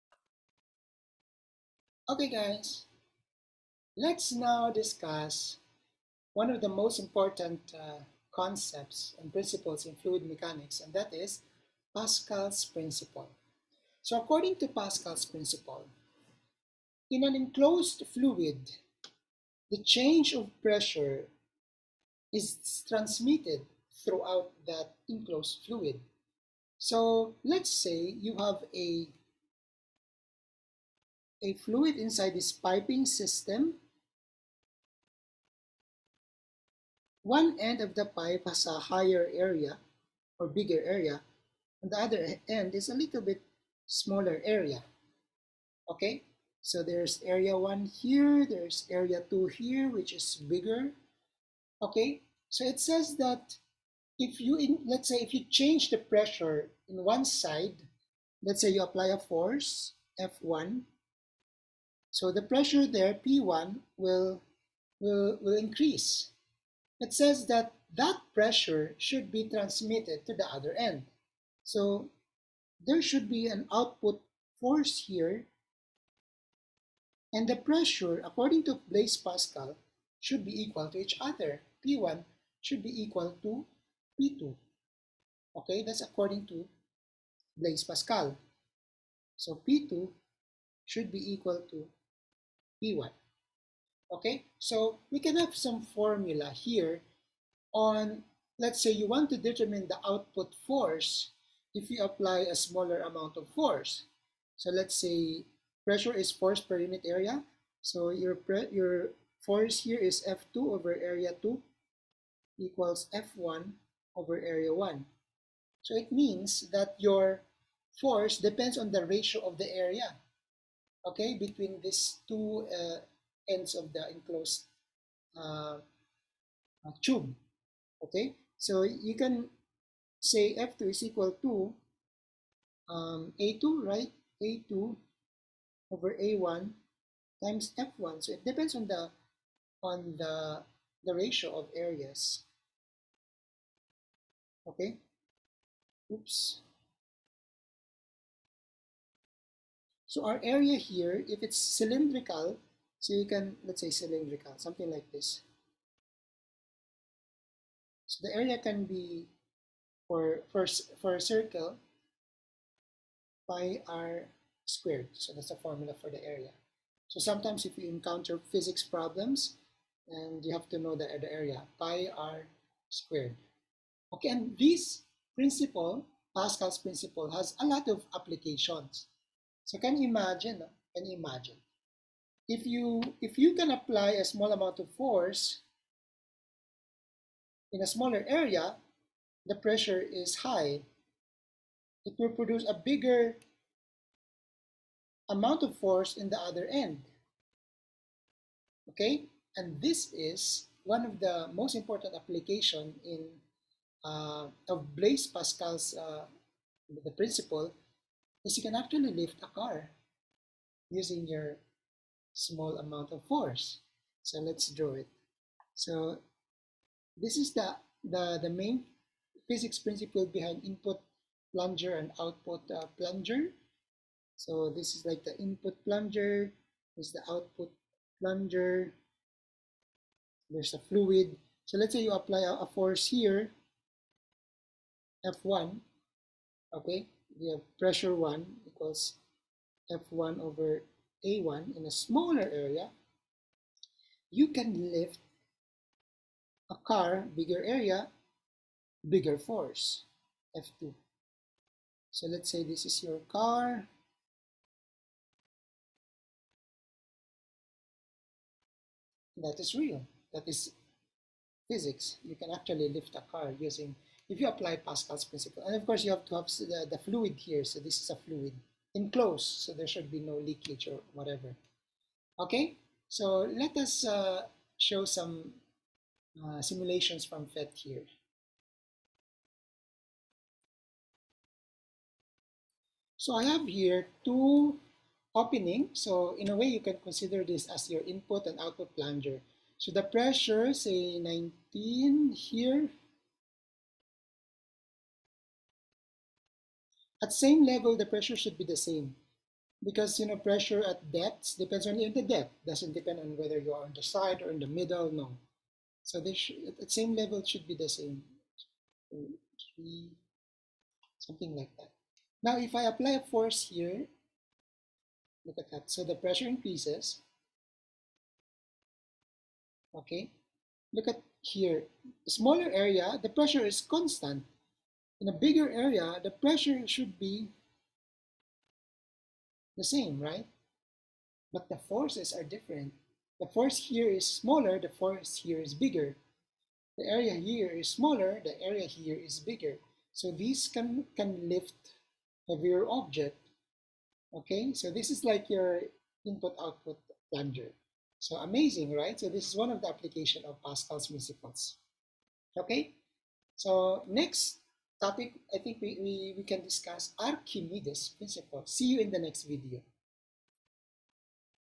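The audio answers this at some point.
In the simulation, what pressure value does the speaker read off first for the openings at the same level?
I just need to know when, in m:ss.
4:51.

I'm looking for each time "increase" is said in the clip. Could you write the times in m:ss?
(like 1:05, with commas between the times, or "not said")
1:05, 5:16.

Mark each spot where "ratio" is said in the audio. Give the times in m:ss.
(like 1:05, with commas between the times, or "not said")
1:59, 2:21.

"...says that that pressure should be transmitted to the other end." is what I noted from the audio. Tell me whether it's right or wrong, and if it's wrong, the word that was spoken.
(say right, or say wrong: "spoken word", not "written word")
right.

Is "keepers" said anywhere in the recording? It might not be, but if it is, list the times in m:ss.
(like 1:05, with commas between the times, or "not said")
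not said.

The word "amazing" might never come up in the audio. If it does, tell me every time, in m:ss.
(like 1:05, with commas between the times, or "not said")
5:48.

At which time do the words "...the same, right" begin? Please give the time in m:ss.
5:29.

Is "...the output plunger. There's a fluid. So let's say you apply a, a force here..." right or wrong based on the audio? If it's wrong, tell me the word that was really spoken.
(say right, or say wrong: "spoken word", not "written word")
right.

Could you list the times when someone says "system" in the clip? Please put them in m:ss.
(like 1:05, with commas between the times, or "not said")
0:33.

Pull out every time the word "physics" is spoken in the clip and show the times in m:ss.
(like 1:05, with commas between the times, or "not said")
2:48, 3:39, 4:21.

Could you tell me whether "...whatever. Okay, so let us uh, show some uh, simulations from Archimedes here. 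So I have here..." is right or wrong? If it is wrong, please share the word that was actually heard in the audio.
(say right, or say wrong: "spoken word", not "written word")
wrong: "PhET", not "Archimedes".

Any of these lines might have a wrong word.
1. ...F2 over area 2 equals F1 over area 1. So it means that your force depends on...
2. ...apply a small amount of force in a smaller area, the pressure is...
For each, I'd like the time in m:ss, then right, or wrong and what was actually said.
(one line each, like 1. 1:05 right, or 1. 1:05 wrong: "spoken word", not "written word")
1. 1:50 right
2. 3:03 right.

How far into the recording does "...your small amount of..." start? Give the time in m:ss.
3:31.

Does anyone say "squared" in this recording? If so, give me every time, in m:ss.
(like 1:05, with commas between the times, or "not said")
2:44, 2:52.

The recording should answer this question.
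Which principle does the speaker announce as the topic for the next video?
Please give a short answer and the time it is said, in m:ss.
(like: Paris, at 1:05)
Archimedes principle, at 5:57.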